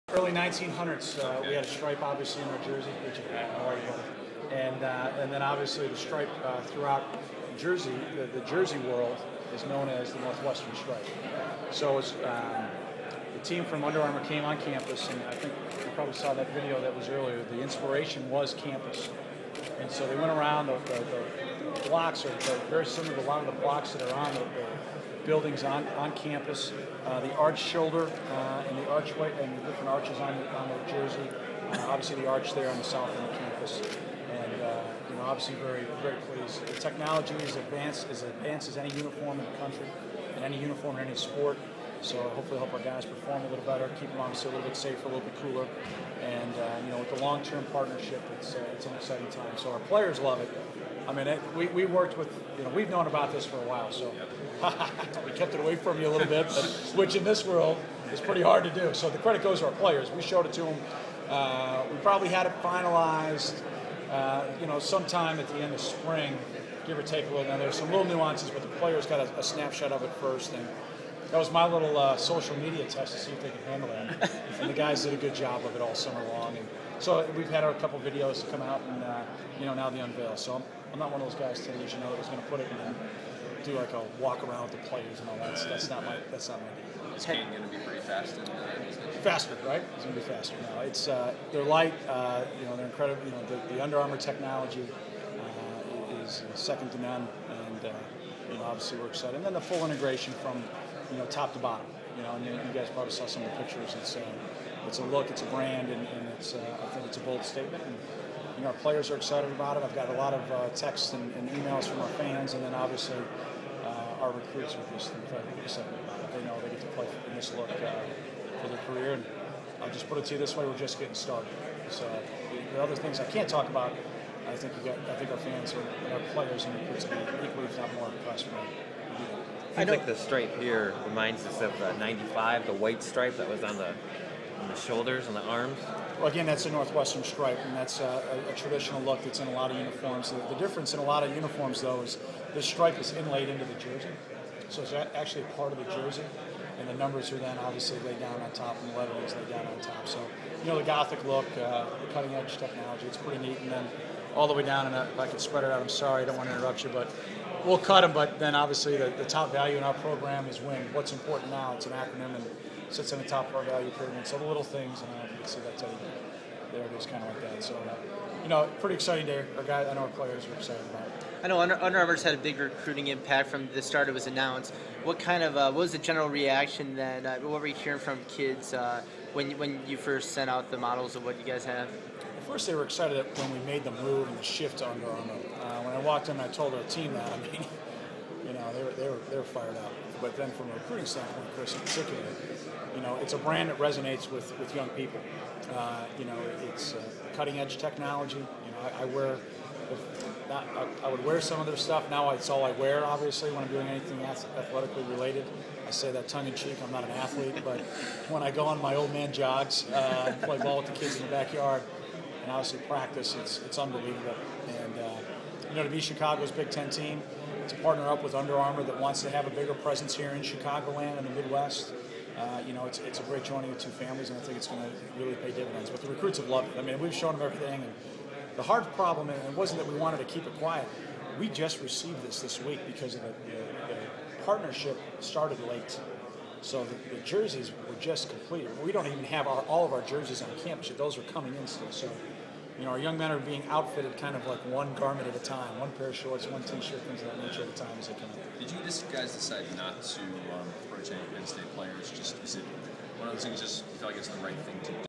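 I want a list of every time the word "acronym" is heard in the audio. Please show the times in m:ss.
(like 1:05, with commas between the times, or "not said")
2:41.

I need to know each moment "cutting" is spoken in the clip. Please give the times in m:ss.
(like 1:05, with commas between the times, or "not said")
2:32, 3:17.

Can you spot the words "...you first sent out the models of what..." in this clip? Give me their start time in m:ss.
2:59.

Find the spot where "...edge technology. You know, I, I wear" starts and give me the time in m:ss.
3:17.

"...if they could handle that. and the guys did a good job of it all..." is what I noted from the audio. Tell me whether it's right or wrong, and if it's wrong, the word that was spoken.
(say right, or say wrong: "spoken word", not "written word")
right.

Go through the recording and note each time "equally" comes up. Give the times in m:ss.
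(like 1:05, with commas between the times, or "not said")
2:07.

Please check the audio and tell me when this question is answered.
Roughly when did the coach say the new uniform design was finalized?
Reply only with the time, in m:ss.
1:05.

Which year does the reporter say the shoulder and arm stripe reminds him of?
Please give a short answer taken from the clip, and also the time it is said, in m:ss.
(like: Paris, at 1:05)
95, at 2:11.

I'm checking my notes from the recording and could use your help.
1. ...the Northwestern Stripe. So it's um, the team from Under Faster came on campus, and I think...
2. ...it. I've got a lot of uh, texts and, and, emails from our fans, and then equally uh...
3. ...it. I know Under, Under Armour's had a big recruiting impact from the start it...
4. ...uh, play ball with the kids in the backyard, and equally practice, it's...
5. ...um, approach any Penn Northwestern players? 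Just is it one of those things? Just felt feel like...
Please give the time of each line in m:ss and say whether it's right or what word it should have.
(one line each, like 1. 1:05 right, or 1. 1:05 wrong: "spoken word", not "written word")
1. 0:10 wrong: "Armour", not "Faster"
2. 1:49 wrong: "obviously", not "equally"
3. 2:51 right
4. 3:29 wrong: "obviously", not "equally"
5. 4:10 wrong: "State", not "Northwestern".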